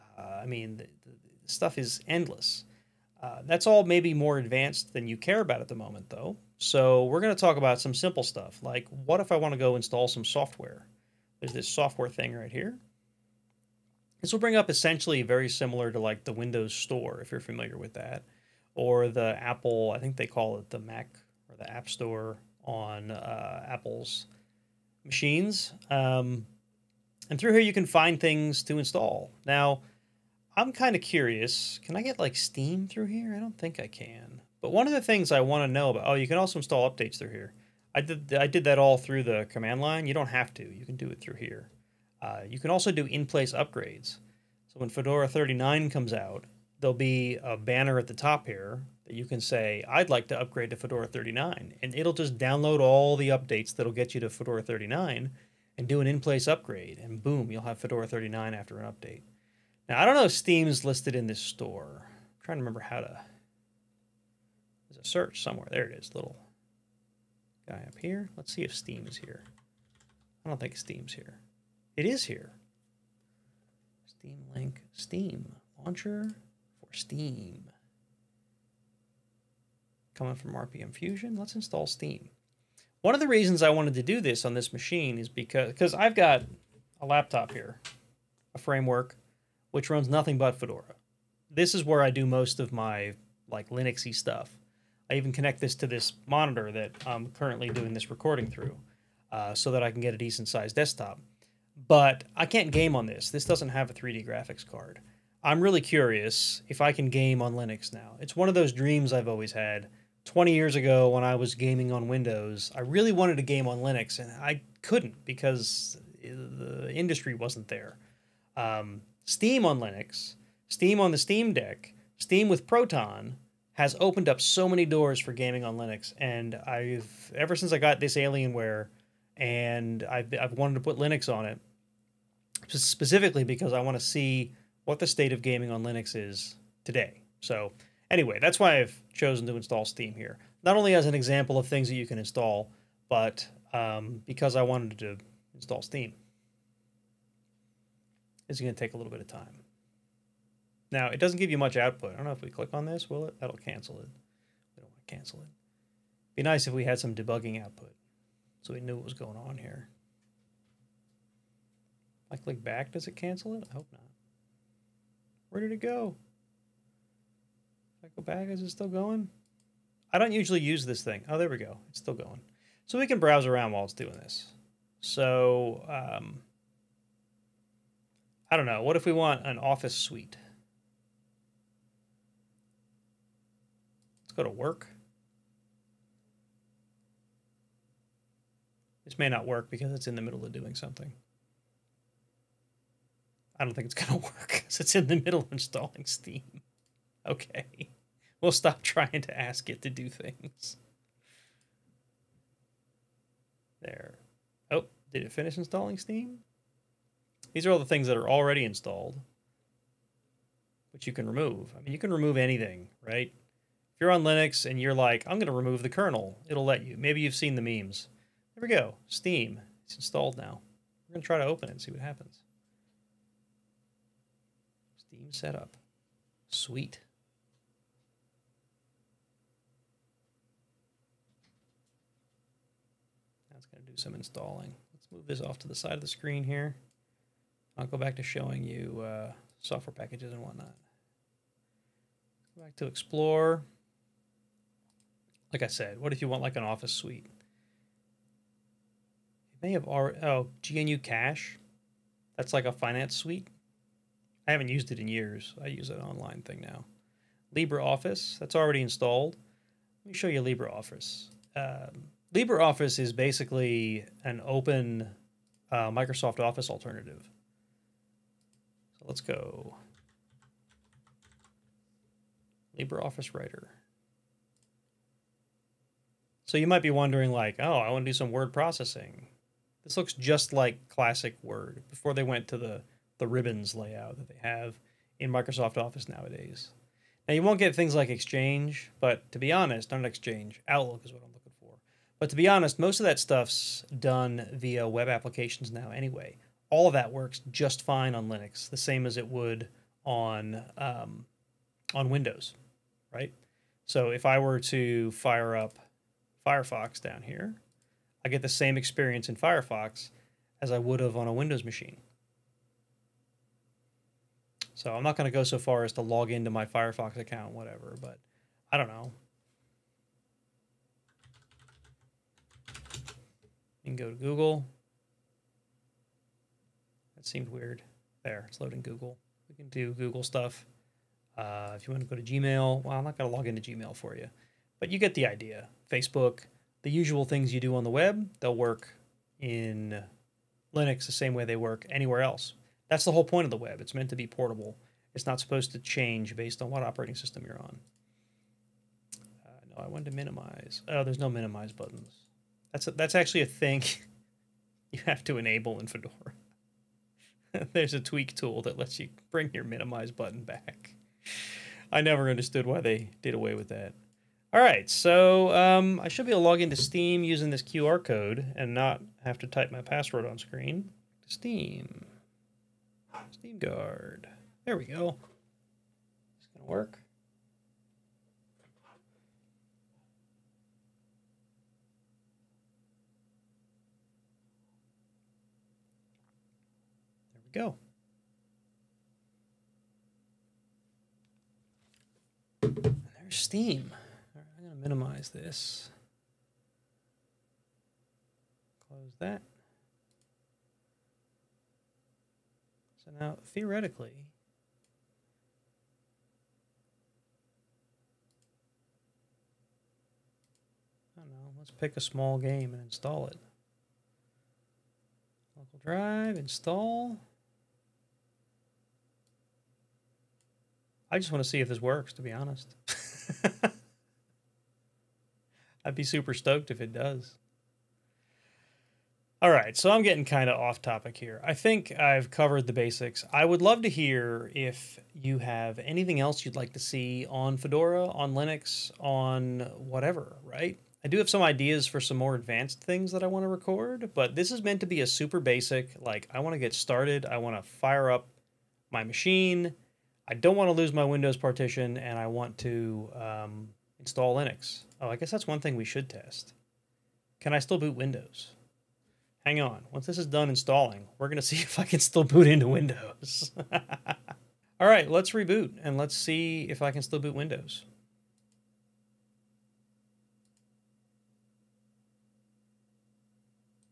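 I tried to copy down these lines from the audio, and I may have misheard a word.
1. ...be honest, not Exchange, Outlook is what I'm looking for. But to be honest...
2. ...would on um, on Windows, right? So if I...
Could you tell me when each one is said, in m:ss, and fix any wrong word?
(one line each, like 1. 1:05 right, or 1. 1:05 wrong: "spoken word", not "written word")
1. 4:49 right
2. 4:59 right.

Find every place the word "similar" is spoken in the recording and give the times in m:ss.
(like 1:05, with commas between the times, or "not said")
0:15.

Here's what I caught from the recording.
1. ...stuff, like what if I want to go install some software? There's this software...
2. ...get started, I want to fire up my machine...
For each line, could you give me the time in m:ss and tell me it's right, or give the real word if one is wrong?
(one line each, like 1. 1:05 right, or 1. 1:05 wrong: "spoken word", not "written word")
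1. 0:08 right
2. 7:26 right.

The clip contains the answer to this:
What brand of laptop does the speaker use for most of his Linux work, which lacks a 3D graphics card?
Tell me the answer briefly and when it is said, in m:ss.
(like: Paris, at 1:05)
Framework, at 1:28.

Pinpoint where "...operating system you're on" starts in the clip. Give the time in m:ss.
5:46.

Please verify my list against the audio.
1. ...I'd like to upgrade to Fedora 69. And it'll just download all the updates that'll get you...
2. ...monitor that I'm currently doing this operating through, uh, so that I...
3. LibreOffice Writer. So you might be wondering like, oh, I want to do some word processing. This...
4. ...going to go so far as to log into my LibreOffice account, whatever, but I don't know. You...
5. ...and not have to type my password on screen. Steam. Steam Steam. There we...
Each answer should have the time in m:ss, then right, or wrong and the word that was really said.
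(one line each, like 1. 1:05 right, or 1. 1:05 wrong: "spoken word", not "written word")
1. 0:49 wrong: "39", not "69"
2. 1:36 wrong: "recording", not "operating"
3. 4:32 right
4. 5:15 wrong: "Firefox", not "LibreOffice"
5. 6:08 wrong: "Guard", not "Steam".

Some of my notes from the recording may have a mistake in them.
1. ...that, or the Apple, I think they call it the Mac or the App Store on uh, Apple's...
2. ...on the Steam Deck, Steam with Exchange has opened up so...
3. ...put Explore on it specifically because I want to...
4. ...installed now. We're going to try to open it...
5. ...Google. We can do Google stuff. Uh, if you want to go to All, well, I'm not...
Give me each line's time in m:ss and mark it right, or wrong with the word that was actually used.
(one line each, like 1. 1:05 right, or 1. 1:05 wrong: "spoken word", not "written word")
1. 0:17 right
2. 2:01 wrong: "Proton", not "Exchange"
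3. 2:10 wrong: "Linux", not "Explore"
4. 3:39 right
5. 5:28 wrong: "Gmail", not "All".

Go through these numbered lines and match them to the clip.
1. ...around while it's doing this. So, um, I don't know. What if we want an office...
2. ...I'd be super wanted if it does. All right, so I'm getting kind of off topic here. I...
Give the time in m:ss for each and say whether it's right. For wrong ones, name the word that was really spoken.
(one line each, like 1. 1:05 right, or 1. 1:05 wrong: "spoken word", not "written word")
1. 2:53 right
2. 7:05 wrong: "stoked", not "wanted".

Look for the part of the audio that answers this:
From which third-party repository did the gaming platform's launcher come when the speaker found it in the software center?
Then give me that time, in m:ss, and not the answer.
1:20.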